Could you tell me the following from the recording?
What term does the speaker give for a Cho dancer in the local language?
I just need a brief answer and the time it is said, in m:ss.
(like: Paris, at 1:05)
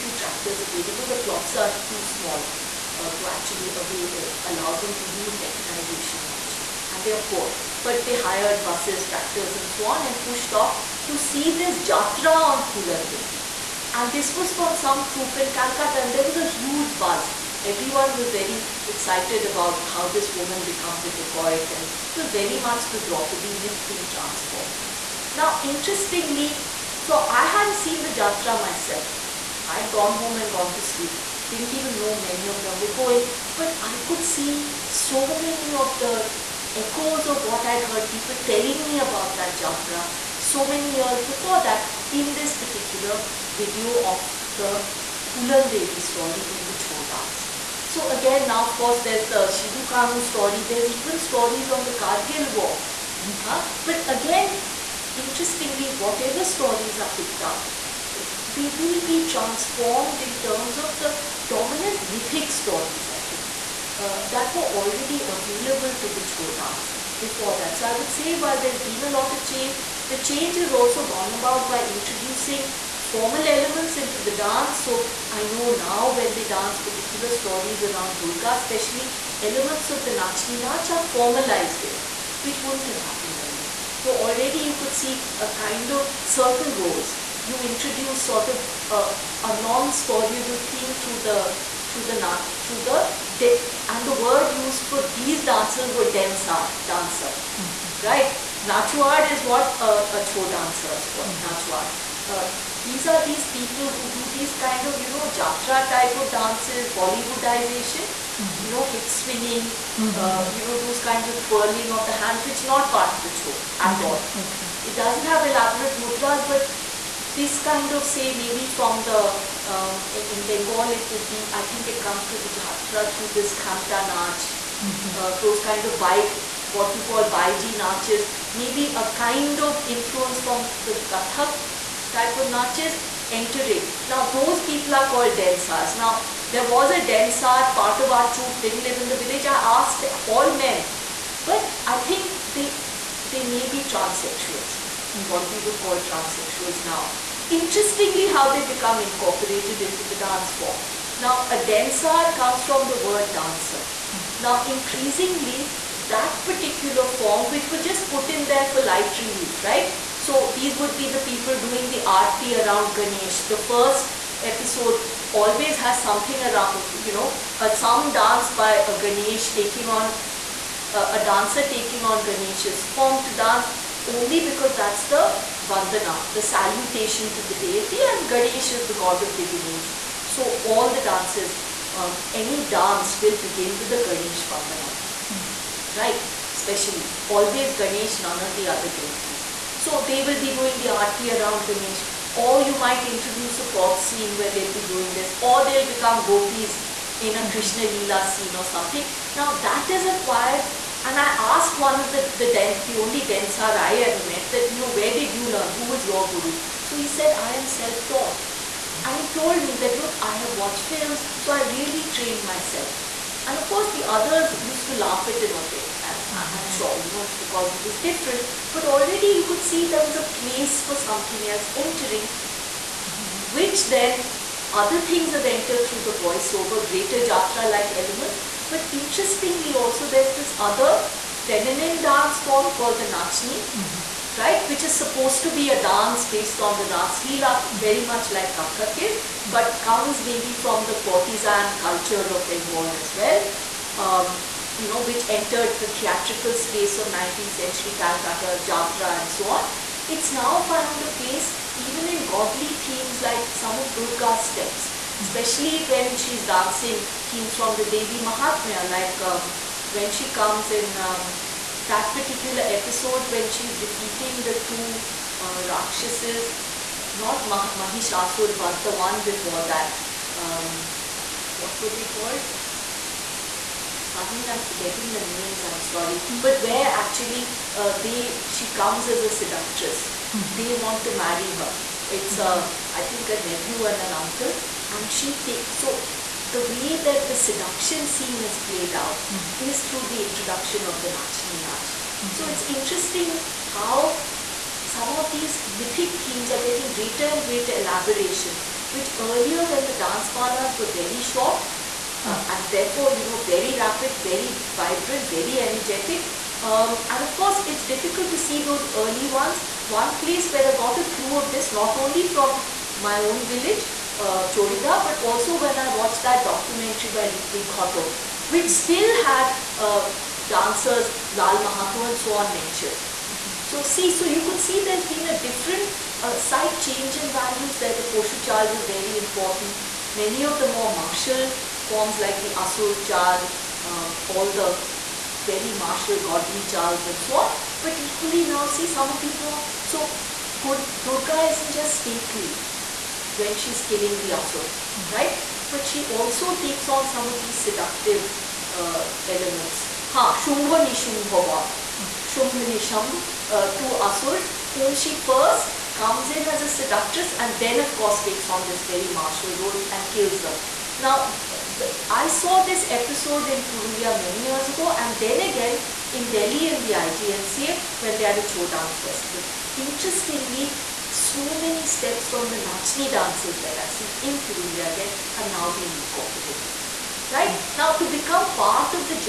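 Nachuar, at 1:38.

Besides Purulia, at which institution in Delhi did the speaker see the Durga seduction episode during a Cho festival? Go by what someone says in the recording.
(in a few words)
IGNCA.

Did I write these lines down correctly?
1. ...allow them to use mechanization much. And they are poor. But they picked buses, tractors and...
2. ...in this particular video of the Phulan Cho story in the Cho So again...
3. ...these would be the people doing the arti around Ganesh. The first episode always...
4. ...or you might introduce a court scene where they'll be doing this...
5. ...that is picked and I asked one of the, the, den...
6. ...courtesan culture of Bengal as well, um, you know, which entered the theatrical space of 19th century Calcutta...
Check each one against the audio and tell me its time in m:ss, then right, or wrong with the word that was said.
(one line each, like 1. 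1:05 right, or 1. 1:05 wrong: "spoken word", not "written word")
1. 0:04 wrong: "hired", not "picked"
2. 0:42 wrong: "Devi", not "Cho"
3. 2:40 right
4. 3:12 right
5. 3:19 wrong: "acquired", not "picked"
6. 4:01 right.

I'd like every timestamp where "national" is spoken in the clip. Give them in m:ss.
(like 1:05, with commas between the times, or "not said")
not said.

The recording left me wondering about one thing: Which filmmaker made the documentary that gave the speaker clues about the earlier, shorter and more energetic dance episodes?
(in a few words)
Ritwik Ghatak.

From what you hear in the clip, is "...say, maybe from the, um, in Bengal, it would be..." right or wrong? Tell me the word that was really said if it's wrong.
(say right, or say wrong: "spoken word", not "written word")
right.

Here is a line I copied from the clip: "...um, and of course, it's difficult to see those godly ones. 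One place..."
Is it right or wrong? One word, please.
wrong.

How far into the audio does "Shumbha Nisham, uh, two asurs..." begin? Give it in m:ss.
5:52.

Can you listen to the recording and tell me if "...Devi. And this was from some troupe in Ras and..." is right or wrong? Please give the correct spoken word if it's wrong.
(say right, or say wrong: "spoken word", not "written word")
wrong: "Calcutta", not "Ras".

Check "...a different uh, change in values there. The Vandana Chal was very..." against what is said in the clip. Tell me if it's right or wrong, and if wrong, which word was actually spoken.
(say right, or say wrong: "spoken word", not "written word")
wrong: "Poshu", not "Vandana".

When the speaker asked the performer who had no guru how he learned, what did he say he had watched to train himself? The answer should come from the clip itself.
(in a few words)
films.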